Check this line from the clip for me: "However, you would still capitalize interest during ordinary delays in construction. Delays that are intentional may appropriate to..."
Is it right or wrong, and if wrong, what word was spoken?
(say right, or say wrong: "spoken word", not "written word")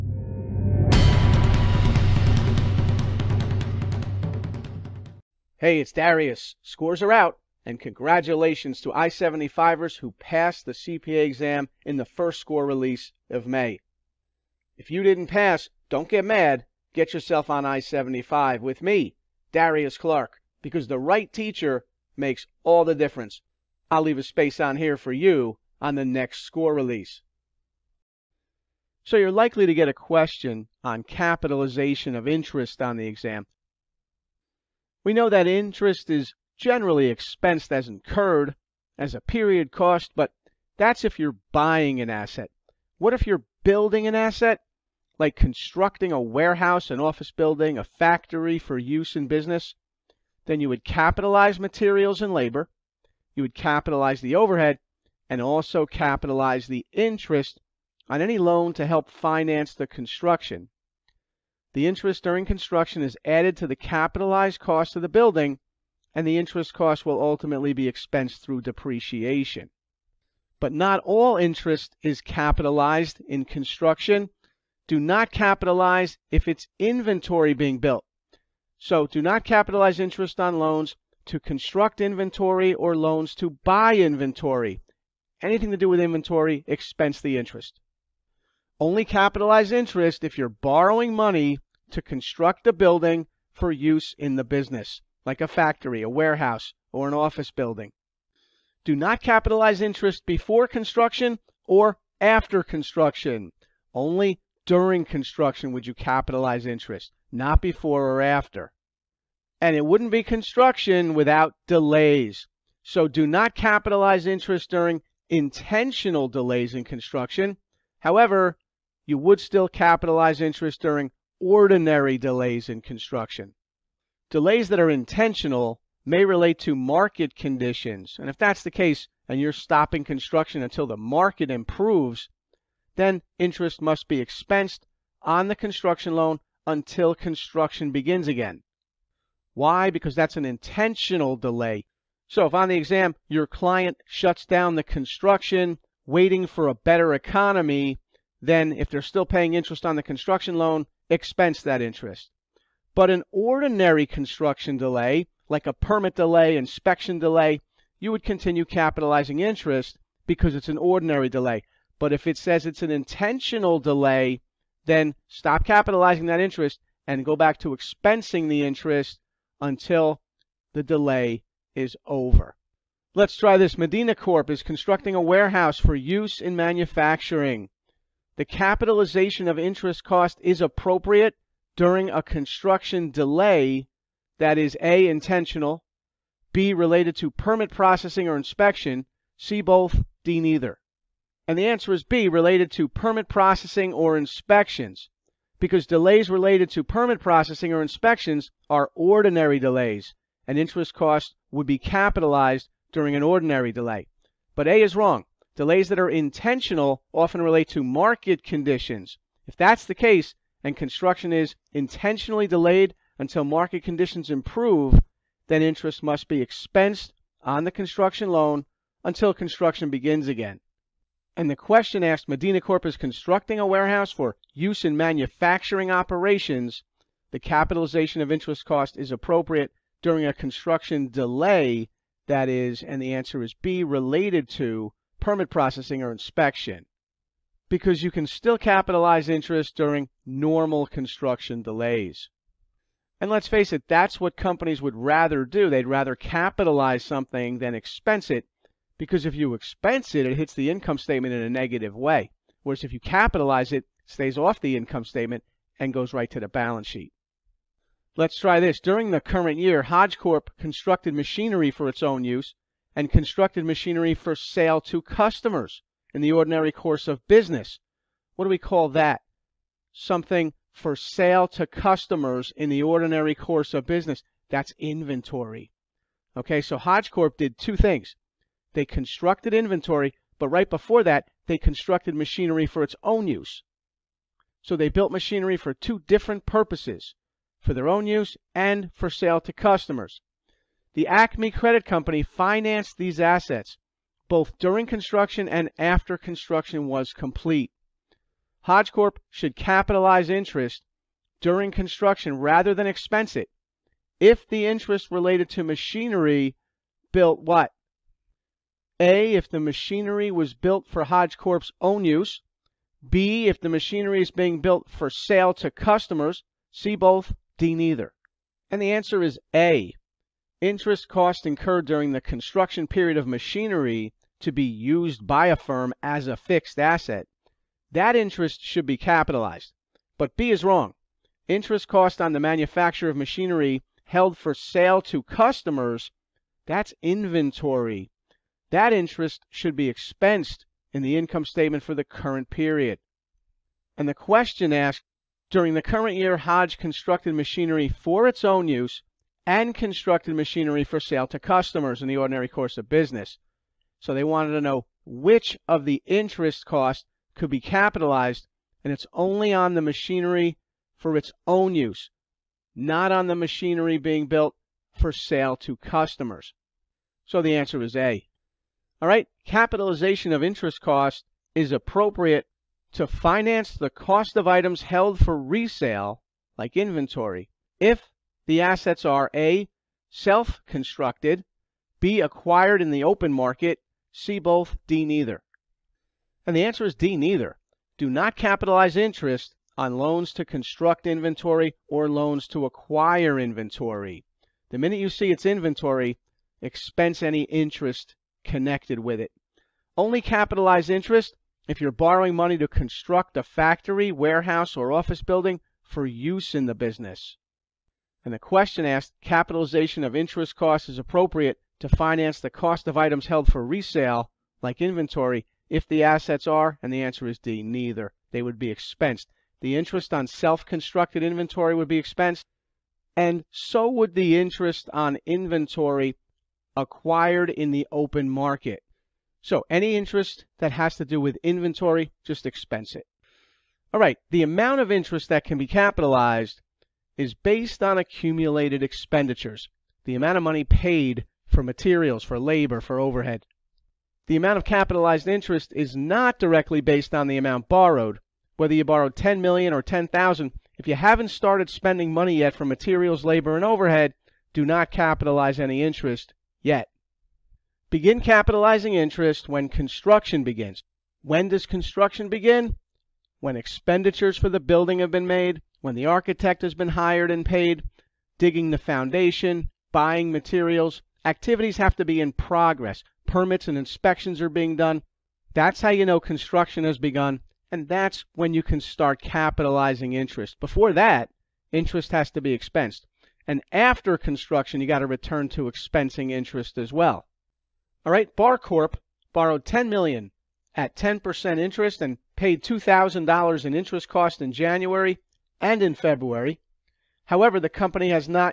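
wrong: "relate", not "appropriate".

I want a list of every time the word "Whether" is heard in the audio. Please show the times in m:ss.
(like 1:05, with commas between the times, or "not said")
7:28.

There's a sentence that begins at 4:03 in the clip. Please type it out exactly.
And let's face it, that's what companies would rather do.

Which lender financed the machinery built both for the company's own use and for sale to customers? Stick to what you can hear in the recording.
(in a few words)
Acme Credit Company.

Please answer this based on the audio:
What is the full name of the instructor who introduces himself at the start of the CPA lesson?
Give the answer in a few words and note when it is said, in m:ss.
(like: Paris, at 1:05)
Darius Clark, at 0:19.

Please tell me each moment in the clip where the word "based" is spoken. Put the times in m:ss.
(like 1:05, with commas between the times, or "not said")
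7:17, 7:26.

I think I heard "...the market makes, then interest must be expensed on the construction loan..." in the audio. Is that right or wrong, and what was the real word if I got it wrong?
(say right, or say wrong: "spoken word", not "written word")
wrong: "improves", not "makes".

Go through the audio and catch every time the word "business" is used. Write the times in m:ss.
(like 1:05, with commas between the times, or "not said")
0:49, 1:34, 4:27, 4:33, 5:52, 6:46.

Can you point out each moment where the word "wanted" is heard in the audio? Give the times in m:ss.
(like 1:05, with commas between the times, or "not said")
5:54.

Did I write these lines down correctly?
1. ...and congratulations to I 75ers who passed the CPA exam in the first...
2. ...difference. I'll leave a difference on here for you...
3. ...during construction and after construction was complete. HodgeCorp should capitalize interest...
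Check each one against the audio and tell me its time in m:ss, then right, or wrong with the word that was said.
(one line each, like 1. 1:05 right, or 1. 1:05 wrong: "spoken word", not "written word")
1. 0:07 right
2. 0:22 wrong: "space", not "difference"
3. 4:54 right.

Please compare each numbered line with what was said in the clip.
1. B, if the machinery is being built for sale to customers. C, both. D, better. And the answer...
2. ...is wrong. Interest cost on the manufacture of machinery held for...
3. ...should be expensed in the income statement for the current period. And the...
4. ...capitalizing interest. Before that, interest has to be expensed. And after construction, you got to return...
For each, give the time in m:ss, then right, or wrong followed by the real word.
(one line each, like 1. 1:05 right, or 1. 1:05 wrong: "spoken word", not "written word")
1. 5:13 wrong: "neither", not "better"
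2. 5:30 right
3. 5:39 right
4. 7:59 right.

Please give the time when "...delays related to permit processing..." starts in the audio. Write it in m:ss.
3:15.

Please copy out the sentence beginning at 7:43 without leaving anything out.
When expenditures for the building have been made when the architect has been hired and paid, digging the foundation, buying materials.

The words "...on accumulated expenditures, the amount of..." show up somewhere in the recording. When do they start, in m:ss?
7:17.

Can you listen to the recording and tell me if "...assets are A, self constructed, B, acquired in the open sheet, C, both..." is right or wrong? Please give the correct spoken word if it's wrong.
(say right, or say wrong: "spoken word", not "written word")
wrong: "market", not "sheet".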